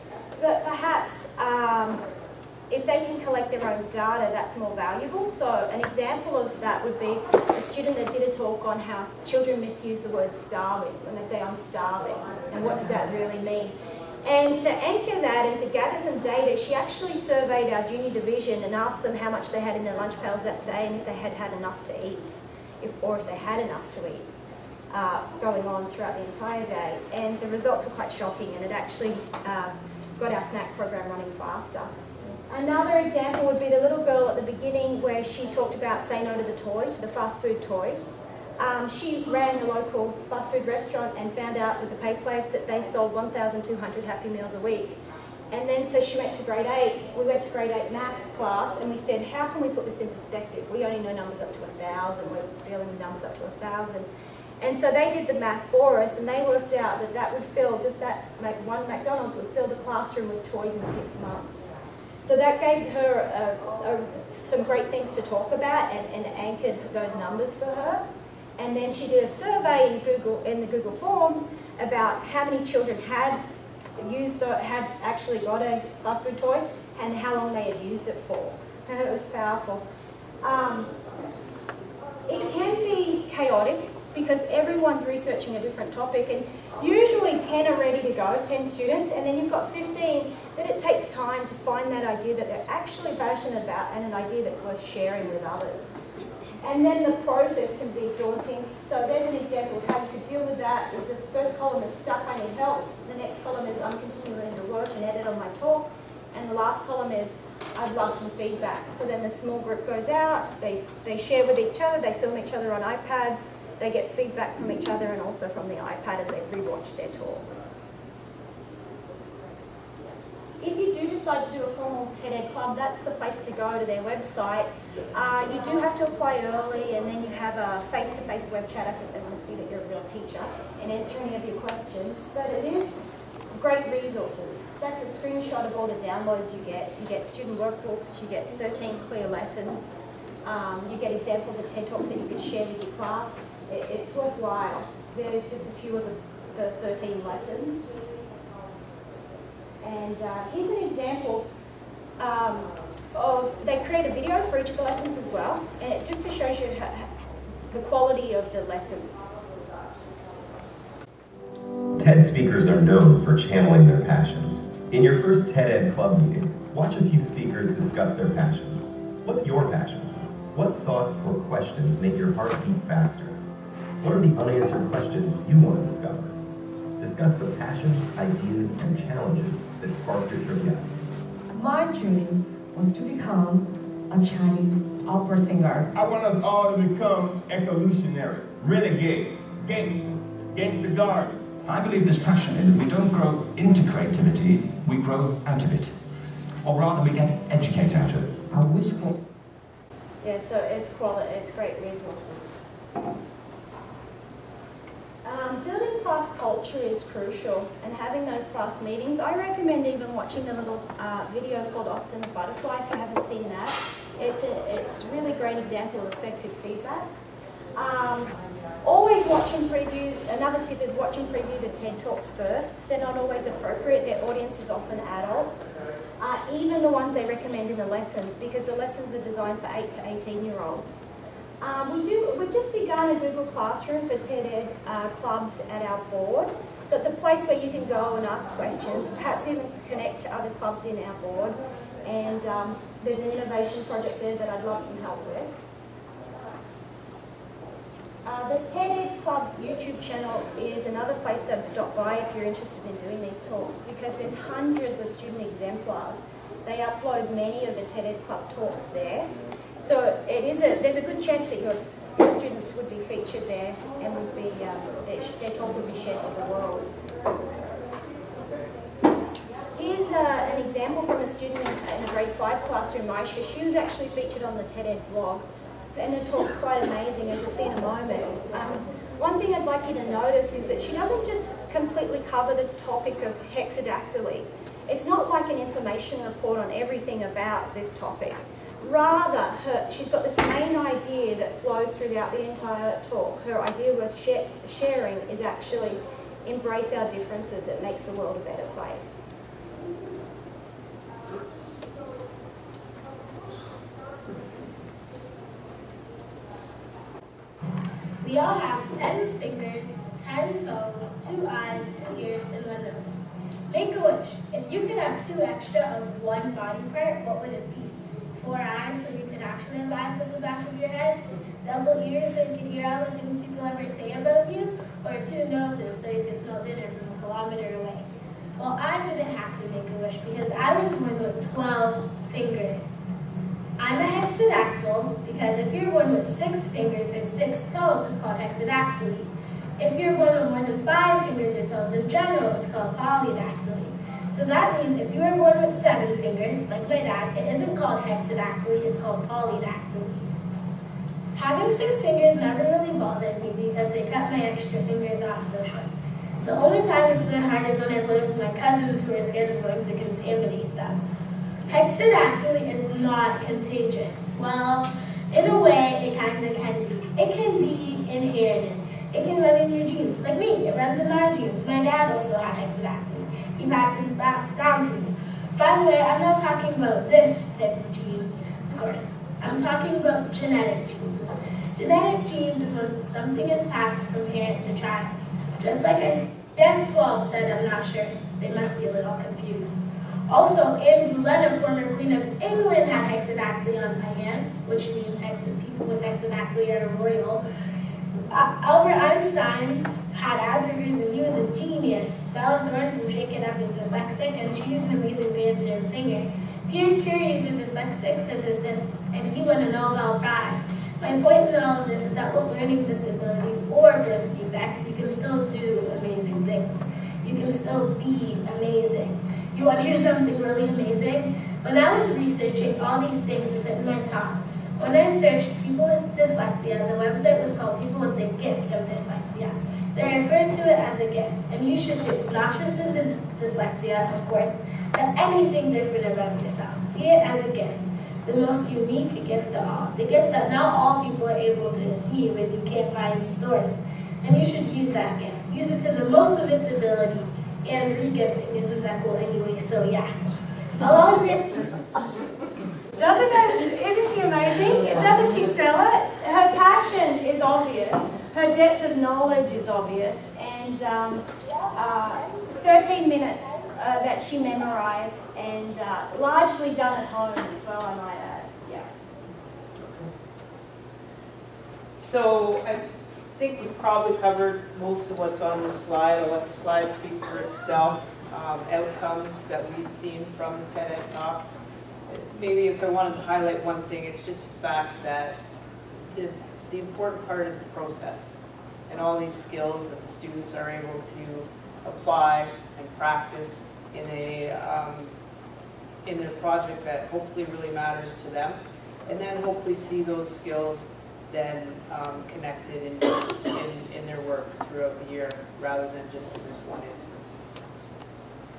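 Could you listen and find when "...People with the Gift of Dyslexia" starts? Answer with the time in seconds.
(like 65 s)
427 s.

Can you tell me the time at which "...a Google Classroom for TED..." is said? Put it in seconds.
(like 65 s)
233 s.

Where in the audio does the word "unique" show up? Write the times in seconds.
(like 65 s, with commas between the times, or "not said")
438 s.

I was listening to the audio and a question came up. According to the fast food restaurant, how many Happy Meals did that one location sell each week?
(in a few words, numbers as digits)
1,200.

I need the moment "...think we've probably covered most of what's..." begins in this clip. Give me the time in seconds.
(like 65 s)
473 s.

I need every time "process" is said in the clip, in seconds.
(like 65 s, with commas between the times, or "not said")
97 s, 487 s.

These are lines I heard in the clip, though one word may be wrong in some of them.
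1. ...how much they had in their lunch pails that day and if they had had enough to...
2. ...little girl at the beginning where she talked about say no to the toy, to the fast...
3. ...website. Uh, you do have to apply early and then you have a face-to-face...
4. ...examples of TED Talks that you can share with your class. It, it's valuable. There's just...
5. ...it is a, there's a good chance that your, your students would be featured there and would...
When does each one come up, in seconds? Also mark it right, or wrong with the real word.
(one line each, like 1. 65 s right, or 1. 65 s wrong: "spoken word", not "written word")
1. 19 s right
2. 33 s right
3. 124 s right
4. 141 s wrong: "worthwhile", not "valuable"
5. 260 s right.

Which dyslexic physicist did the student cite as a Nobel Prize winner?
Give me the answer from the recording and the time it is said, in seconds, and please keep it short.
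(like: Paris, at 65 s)
Pierre Curie, at 406 s.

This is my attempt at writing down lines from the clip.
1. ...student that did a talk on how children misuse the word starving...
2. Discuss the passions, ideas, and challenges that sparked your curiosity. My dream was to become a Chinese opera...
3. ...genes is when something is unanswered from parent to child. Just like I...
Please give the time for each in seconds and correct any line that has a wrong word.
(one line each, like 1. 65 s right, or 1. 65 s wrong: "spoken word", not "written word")
1. 7 s right
2. 177 s right
3. 382 s wrong: "passed", not "unanswered".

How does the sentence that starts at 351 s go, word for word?
Having six fingers never really bothered me because they cut my extra fingers off so short.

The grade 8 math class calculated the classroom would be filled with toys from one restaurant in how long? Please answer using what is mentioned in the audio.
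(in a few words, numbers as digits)
six months.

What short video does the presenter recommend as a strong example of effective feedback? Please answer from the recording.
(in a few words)
Austin the Butterfly.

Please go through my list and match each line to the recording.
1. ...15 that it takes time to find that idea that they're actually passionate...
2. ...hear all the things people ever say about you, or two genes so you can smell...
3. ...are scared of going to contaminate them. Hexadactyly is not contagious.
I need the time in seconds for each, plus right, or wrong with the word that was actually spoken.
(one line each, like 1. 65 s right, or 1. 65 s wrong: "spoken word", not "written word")
1. 89 s right
2. 322 s wrong: "noses", not "genes"
3. 359 s right.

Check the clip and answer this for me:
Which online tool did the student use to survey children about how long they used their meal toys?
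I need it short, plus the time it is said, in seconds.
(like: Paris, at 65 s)
Google Forms, at 70 s.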